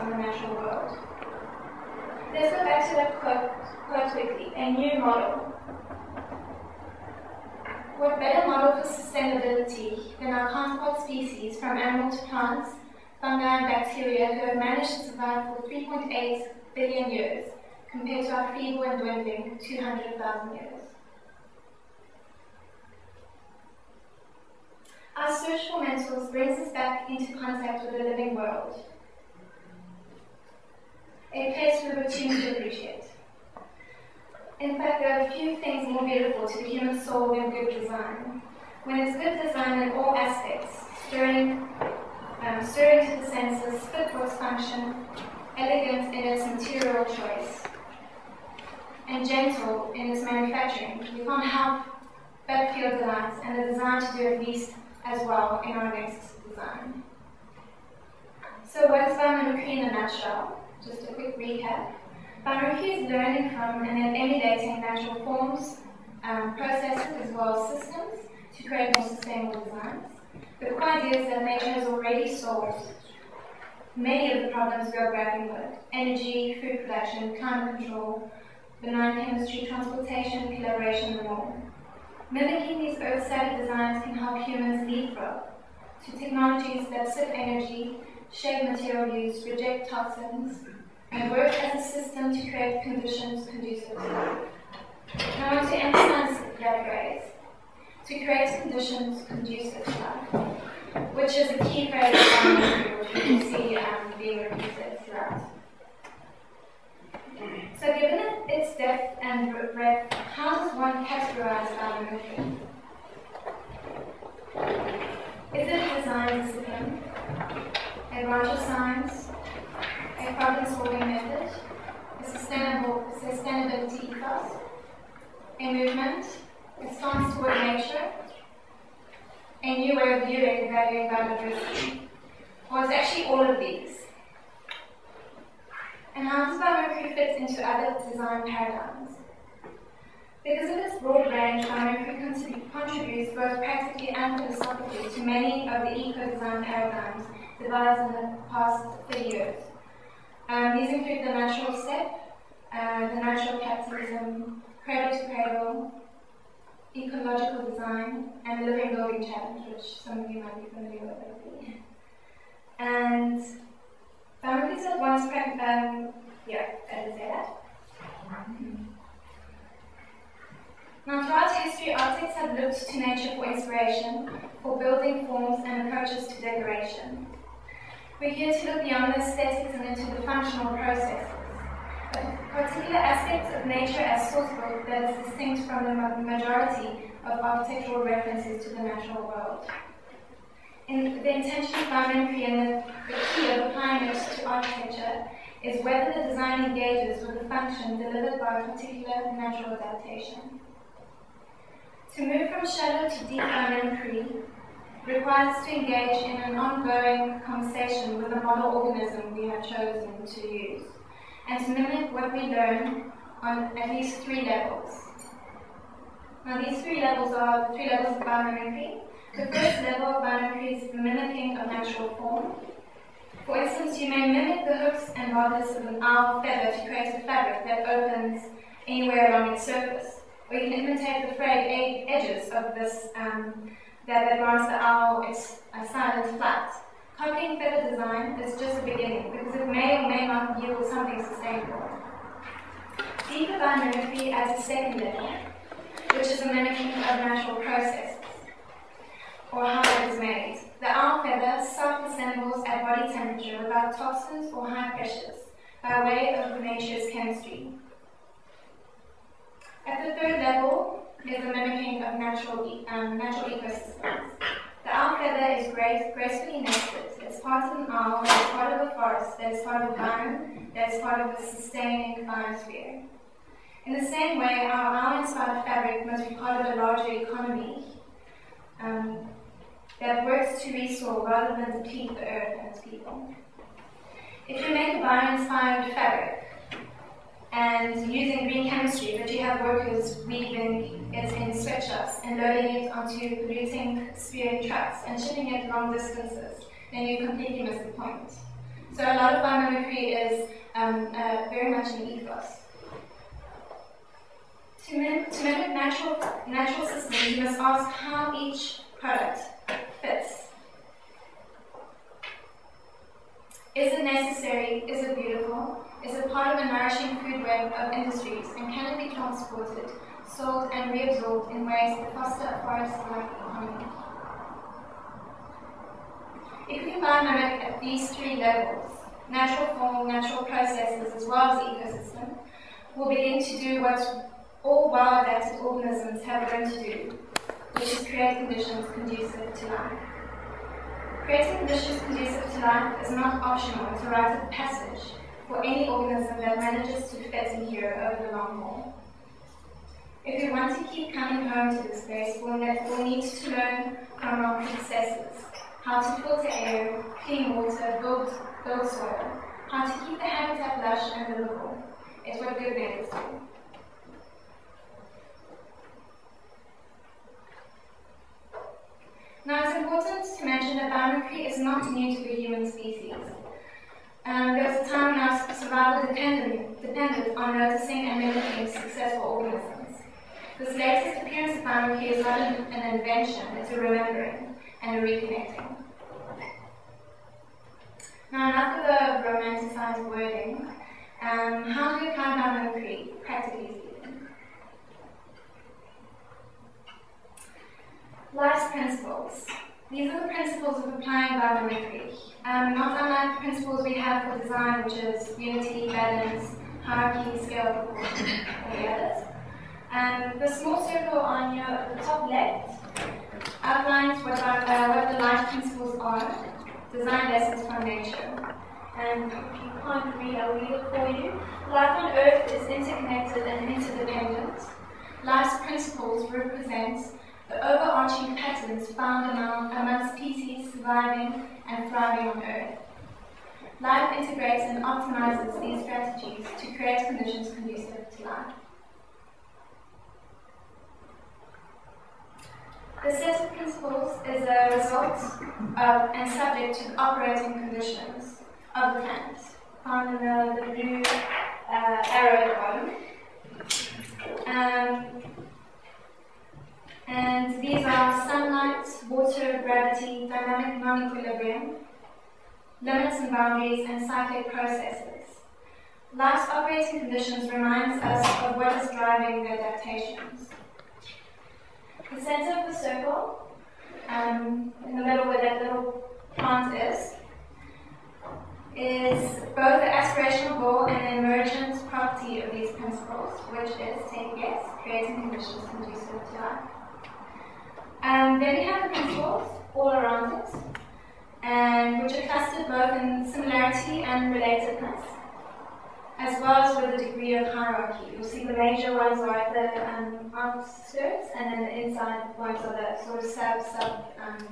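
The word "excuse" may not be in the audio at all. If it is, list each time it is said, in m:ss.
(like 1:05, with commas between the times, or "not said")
not said.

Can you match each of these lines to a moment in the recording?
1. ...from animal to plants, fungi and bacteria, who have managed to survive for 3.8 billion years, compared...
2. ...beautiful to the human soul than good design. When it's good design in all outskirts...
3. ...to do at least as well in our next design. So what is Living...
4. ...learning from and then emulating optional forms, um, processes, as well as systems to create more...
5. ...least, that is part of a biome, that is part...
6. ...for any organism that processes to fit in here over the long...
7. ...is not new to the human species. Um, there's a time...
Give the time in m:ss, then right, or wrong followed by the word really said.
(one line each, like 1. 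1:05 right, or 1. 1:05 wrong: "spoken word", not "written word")
1. 0:11 right
2. 0:36 wrong: "aspects", not "outskirts"
3. 0:53 wrong: "Queen", not "Living"
4. 1:03 wrong: "natural", not "optional"
5. 4:28 wrong: "forest", not "least"
6. 5:45 wrong: "manages", not "processes"
7. 6:11 right.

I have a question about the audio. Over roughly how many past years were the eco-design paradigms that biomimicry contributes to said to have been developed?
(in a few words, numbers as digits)
30 years.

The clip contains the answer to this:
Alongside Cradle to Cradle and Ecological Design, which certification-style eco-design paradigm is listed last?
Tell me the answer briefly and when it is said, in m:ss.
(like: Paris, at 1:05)
Living Building Challenge, at 2:38.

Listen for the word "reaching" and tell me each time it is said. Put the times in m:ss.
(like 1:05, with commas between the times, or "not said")
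not said.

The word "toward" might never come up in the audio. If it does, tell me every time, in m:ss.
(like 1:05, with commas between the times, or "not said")
2:07.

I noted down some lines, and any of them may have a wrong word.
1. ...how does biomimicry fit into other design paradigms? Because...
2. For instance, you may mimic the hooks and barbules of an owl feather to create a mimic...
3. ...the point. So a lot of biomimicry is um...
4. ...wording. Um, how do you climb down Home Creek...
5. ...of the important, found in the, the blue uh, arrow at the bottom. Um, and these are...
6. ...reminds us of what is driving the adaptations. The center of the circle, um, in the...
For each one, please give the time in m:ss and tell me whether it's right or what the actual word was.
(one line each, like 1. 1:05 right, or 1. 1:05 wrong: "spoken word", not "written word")
1. 2:16 right
2. 3:43 wrong: "fabric", not "mimic"
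3. 4:57 right
4. 6:30 right
5. 7:28 wrong: "plant", not "important"
6. 7:47 right.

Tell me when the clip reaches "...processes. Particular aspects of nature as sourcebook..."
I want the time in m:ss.
3:00.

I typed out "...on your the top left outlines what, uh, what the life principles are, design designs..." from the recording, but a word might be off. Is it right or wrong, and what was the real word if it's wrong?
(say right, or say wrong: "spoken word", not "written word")
wrong: "lessons", not "designs".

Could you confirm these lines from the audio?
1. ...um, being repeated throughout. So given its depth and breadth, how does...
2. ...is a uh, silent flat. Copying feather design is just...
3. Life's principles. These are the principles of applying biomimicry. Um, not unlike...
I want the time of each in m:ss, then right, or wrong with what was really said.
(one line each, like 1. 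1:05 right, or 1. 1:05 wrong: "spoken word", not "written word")
1. 1:43 right
2. 3:55 right
3. 6:38 right.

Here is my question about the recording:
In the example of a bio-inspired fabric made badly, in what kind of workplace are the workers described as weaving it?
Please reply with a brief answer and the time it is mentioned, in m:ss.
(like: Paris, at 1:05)
Sweatshops, at 4:51.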